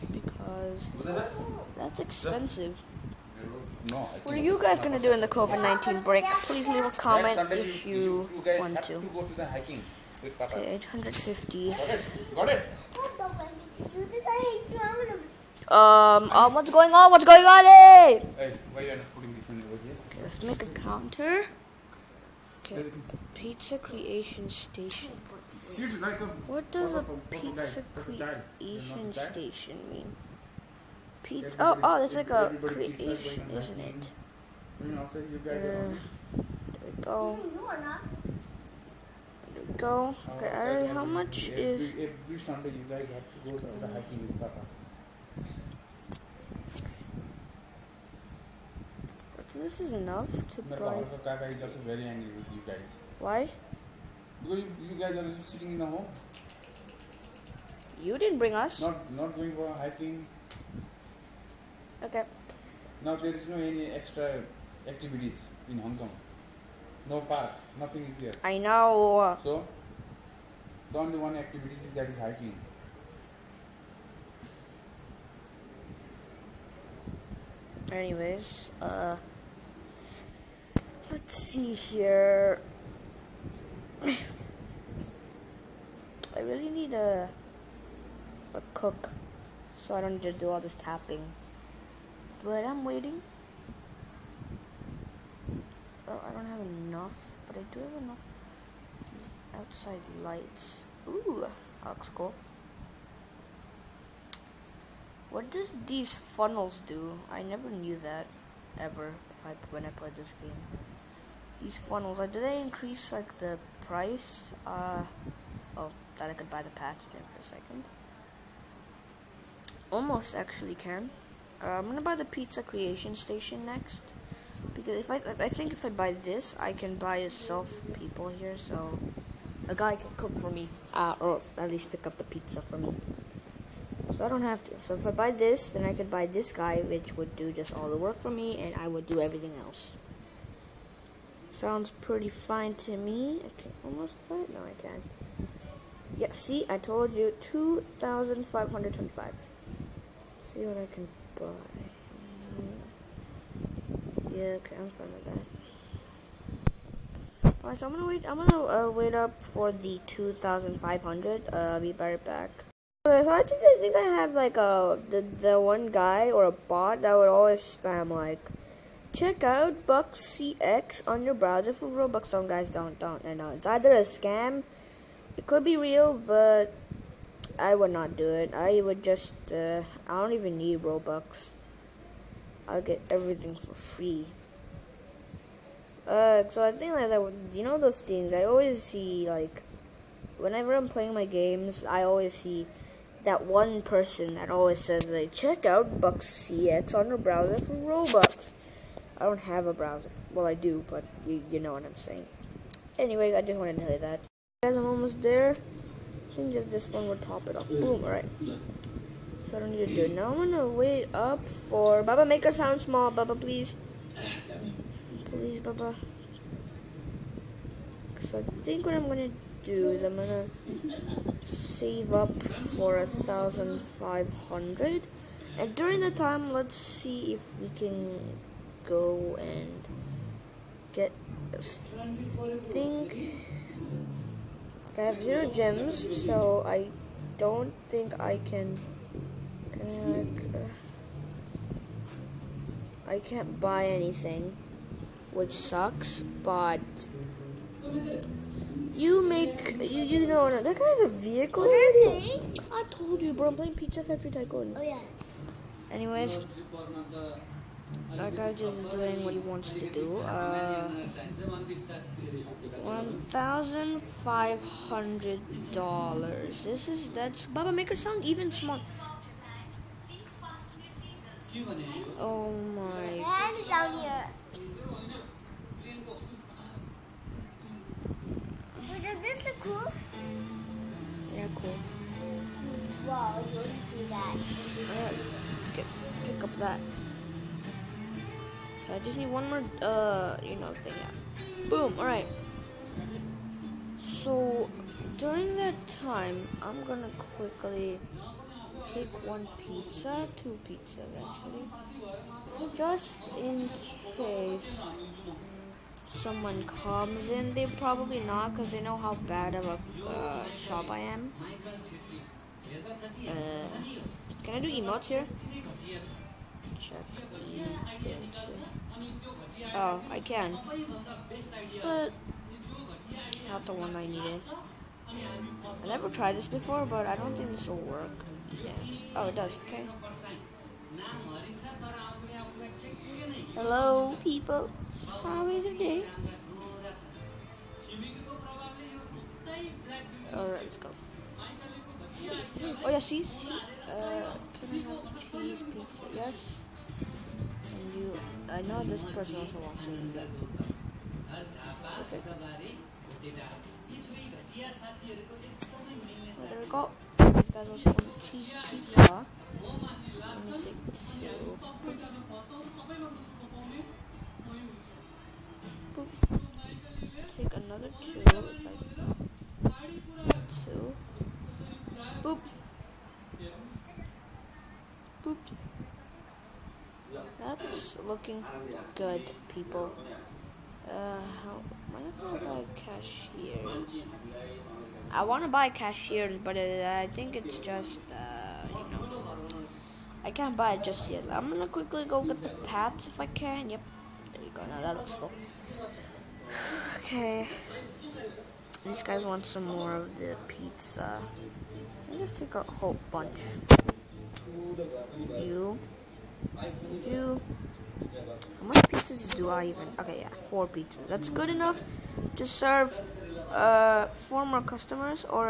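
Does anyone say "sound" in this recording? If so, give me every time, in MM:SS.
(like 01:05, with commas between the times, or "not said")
02:21, 03:32, 04:27.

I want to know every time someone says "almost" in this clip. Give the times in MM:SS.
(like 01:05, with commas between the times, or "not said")
01:59, 02:23, 03:24.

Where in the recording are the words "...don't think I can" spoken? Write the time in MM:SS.
03:57.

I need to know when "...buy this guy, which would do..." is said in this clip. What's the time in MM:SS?
02:16.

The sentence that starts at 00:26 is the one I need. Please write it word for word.
What does a pizza creation station mean?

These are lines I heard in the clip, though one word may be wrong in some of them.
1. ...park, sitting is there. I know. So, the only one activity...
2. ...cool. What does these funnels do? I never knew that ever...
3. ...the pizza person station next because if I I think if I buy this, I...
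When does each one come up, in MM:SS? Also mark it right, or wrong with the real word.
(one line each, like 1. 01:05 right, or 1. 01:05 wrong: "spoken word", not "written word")
1. 01:07 wrong: "nothing", not "sitting"
2. 01:42 right
3. 02:02 wrong: "creation", not "person".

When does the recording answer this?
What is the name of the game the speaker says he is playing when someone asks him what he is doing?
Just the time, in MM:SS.
04:13.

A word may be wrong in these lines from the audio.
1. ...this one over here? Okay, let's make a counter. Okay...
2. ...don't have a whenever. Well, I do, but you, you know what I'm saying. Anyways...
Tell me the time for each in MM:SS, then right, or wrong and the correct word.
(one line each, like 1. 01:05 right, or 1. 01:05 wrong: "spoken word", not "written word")
1. 00:19 right
2. 03:19 wrong: "browser", not "whenever".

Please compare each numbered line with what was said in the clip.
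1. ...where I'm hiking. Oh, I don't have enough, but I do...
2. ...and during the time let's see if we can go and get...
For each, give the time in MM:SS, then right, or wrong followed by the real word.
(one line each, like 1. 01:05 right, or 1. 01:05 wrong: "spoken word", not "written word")
1. 01:32 wrong: "waiting", not "hiking"
2. 03:45 right.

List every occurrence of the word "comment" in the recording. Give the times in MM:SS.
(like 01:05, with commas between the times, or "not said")
00:06.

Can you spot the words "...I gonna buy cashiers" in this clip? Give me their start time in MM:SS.
06:21.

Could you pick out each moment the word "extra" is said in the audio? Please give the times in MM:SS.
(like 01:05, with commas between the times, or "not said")
01:03.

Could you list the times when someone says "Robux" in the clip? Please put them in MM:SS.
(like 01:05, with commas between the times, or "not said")
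02:51, 03:00, 03:17.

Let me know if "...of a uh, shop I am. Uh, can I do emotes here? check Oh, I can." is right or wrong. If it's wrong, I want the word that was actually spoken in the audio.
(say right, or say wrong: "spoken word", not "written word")
right.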